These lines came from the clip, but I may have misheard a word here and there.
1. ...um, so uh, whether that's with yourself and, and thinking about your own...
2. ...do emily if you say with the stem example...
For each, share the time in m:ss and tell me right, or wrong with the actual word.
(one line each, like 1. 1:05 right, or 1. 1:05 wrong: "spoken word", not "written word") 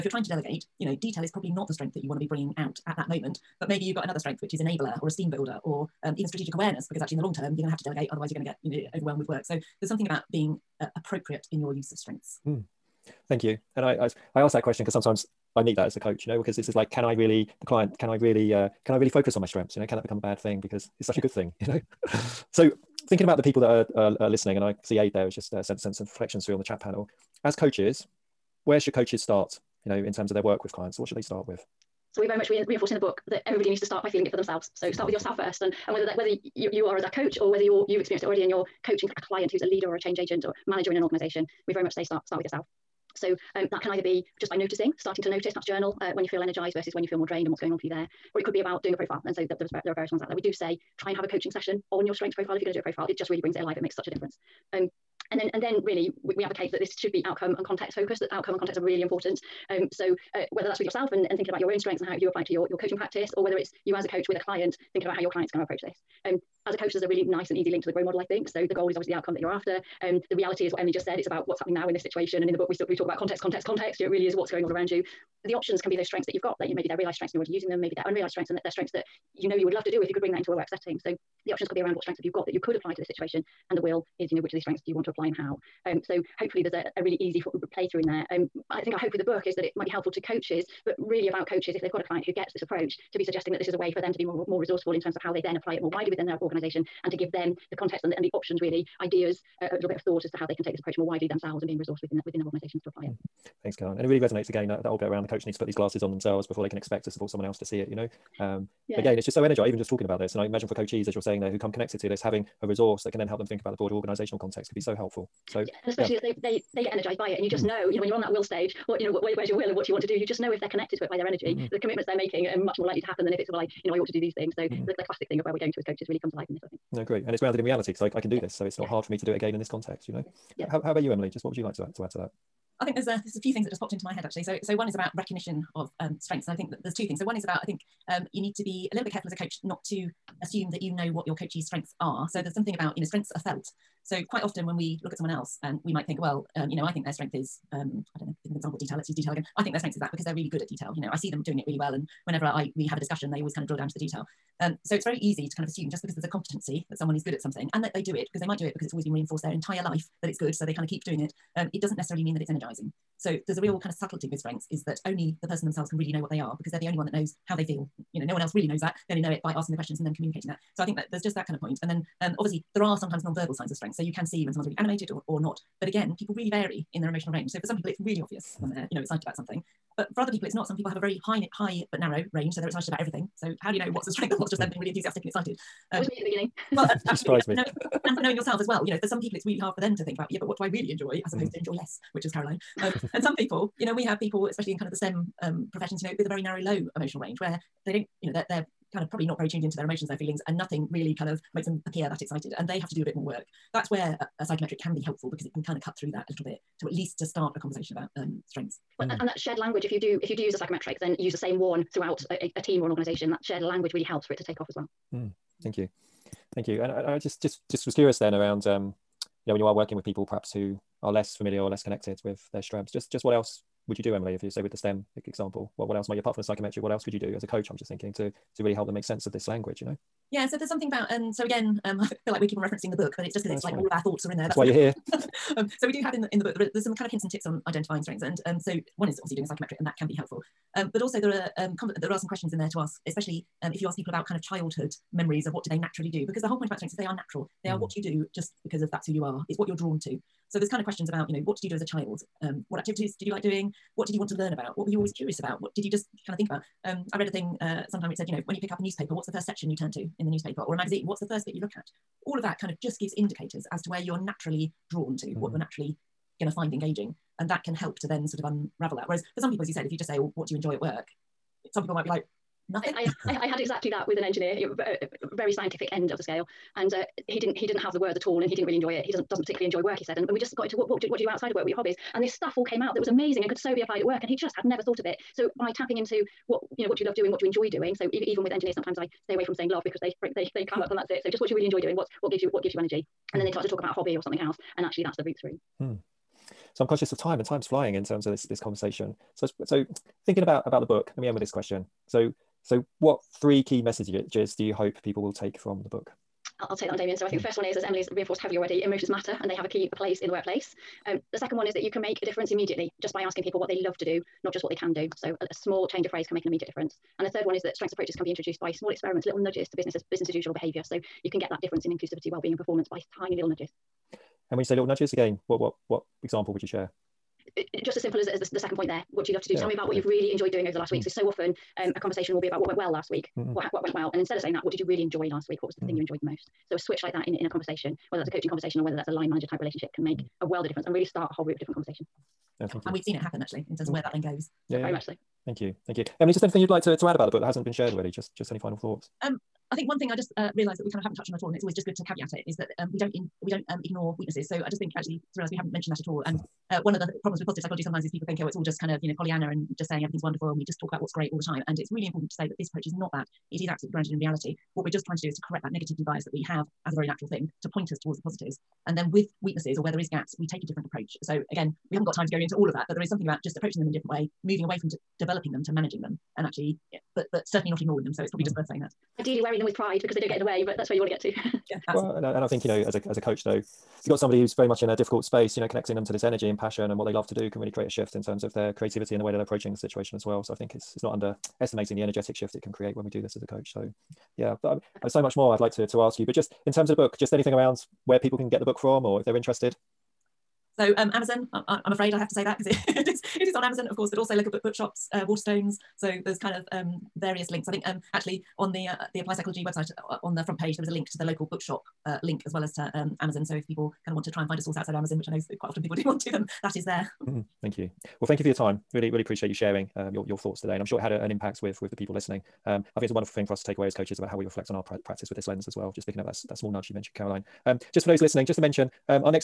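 1. 0:59 right
2. 3:44 right.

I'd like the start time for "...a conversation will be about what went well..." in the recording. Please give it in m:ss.
5:31.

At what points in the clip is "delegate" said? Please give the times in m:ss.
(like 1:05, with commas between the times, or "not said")
0:00, 0:07.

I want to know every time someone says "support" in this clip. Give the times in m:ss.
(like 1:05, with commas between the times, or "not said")
1:47.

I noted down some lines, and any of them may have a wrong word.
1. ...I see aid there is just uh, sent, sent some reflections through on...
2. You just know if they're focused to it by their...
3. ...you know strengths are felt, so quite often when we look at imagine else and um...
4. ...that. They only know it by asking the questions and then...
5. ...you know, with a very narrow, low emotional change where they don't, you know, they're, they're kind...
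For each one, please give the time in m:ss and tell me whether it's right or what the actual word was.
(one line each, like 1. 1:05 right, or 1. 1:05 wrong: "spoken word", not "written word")
1. 0:24 right
2. 2:00 wrong: "connected", not "focused"
3. 2:22 wrong: "someone", not "imagine"
4. 2:48 right
5. 3:16 wrong: "range", not "change".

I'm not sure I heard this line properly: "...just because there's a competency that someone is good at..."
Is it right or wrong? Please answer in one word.
right.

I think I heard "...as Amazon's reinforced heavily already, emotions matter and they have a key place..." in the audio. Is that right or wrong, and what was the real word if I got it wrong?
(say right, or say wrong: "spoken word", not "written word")
wrong: "Emily", not "Amazon".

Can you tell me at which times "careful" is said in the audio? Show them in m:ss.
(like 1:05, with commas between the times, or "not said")
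2:19.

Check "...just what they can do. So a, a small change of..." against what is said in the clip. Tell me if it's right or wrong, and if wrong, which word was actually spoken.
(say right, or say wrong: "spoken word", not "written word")
right.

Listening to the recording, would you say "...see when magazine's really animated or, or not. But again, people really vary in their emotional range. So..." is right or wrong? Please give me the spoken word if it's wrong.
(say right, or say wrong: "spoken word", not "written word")
wrong: "someone", not "magazine".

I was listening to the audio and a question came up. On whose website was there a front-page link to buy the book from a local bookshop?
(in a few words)
Applied Psychology.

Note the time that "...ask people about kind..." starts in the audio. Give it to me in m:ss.
4:03.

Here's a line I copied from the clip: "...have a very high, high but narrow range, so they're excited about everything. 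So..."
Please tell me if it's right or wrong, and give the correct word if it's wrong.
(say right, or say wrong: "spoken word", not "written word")
right.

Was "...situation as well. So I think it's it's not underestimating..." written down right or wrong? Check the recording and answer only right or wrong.
right.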